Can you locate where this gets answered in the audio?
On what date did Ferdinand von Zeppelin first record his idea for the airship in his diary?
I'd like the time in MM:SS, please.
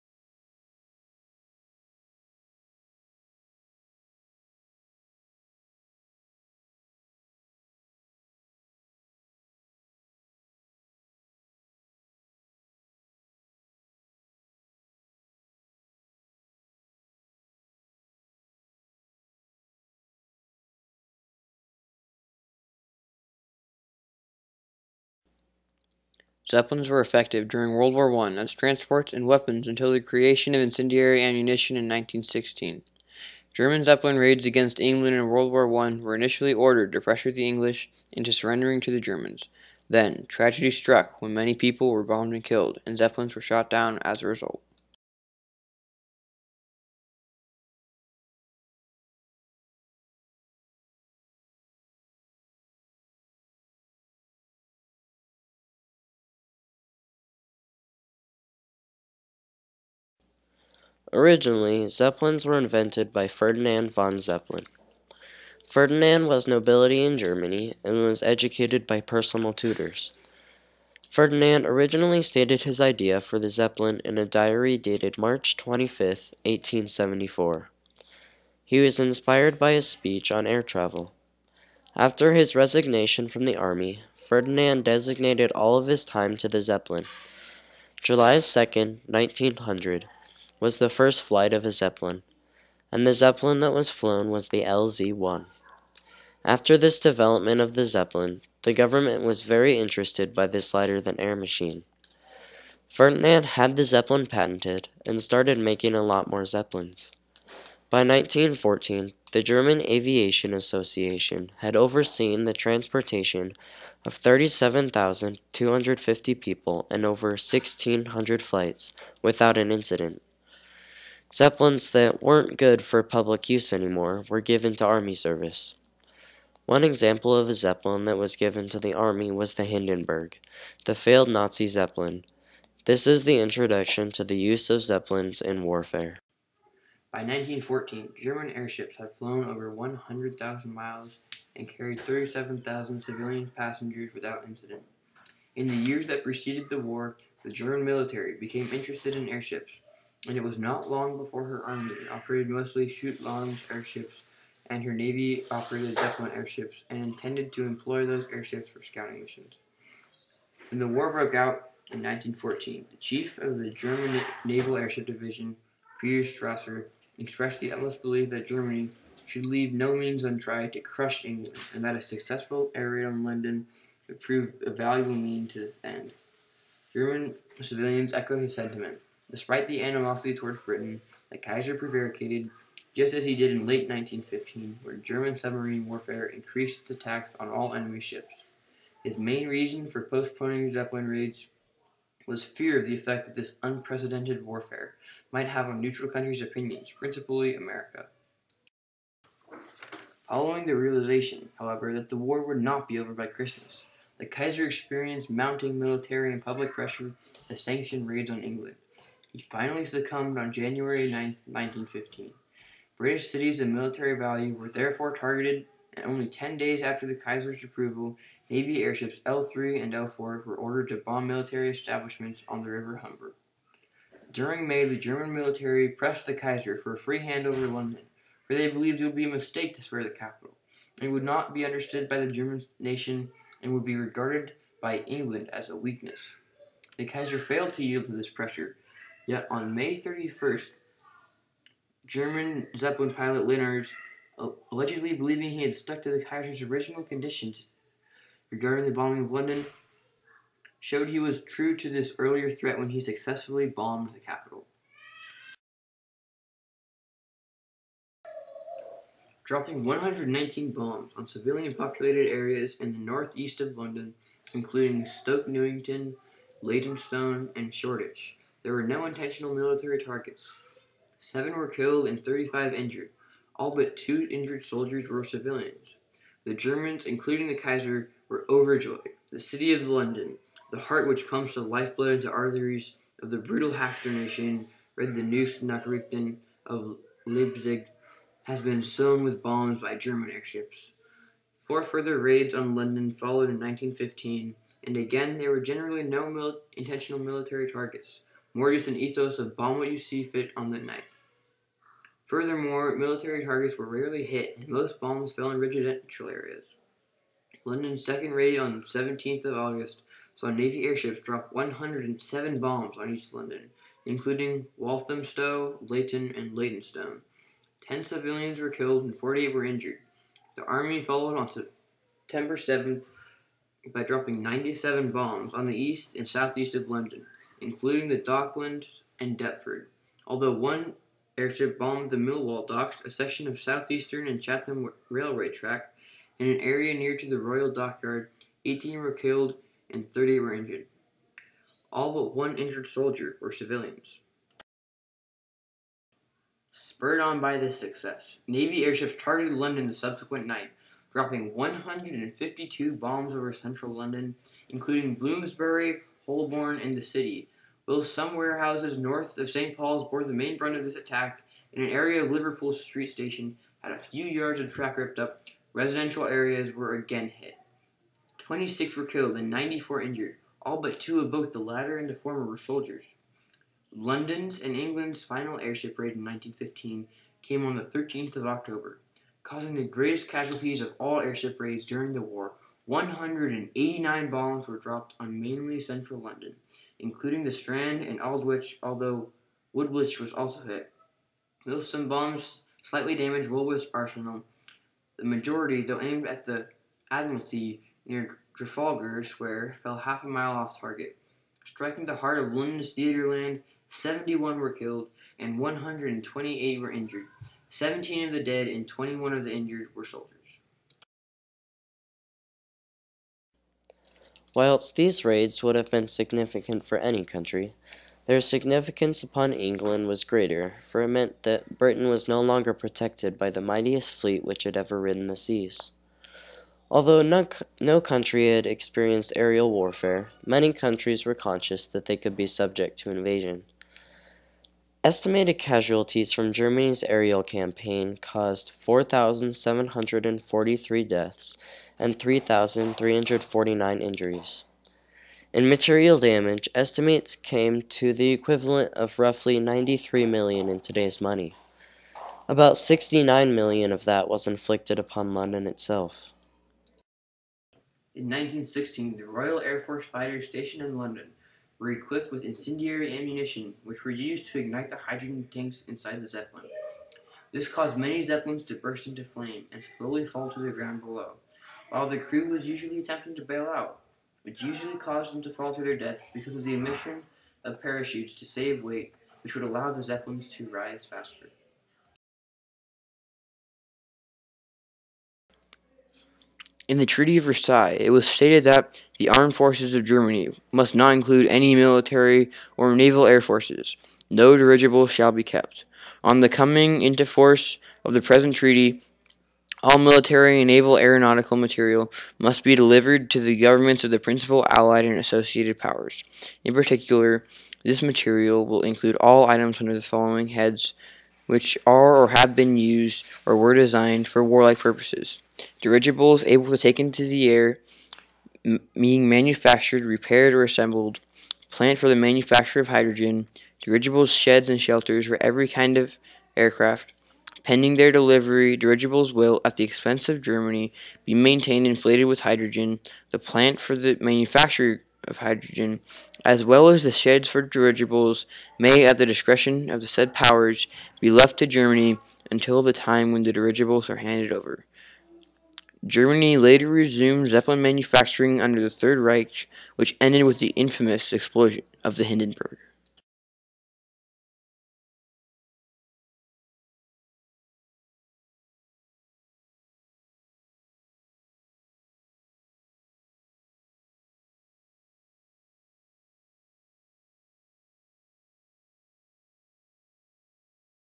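01:15.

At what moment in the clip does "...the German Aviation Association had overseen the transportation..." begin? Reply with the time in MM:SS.
01:49.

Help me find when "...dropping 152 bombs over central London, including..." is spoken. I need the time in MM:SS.
05:51.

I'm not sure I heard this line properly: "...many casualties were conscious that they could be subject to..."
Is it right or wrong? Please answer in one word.
wrong.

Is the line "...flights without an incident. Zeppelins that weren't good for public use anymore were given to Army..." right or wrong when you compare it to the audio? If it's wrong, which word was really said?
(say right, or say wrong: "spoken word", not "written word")
right.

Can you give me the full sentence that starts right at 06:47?
17 of the dead and 21 of the injured were soldiers.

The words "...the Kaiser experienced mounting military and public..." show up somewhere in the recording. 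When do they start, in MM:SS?
03:24.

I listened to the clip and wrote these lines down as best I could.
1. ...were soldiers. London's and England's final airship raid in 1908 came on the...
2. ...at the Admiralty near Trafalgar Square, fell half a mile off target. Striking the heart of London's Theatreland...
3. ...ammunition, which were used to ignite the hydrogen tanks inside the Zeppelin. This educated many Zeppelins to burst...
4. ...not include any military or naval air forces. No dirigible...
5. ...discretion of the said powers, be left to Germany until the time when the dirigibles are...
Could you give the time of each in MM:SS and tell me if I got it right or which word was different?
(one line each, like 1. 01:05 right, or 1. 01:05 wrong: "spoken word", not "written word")
1. 06:12 wrong: "1915", not "1908"
2. 06:36 right
3. 07:43 wrong: "caused", not "educated"
4. 08:10 right
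5. 08:59 right.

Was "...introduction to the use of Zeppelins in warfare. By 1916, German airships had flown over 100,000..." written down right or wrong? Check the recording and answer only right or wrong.
wrong.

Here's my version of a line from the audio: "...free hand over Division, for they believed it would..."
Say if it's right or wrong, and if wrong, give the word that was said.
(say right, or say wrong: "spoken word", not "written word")
wrong: "London", not "Division".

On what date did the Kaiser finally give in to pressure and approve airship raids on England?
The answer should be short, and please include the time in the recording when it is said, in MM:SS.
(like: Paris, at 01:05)
January 9, 1915, at 03:30.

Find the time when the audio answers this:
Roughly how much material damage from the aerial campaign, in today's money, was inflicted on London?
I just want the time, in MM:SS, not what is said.
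07:32.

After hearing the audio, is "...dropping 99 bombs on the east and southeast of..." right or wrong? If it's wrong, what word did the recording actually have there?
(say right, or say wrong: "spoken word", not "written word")
wrong: "97", not "99".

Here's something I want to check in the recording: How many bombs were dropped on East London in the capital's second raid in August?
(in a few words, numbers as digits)
107.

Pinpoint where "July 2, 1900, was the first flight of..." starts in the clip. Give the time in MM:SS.
01:28.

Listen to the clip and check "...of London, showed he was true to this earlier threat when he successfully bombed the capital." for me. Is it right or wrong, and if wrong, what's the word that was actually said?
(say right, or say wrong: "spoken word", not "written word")
right.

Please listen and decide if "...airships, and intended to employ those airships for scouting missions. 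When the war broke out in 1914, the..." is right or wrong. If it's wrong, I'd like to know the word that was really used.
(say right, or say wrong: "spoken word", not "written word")
right.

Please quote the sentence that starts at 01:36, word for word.
After this development of the Zeppelin, the government was very interested by this lighter than air machine.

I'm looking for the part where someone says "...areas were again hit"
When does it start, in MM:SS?
06:06.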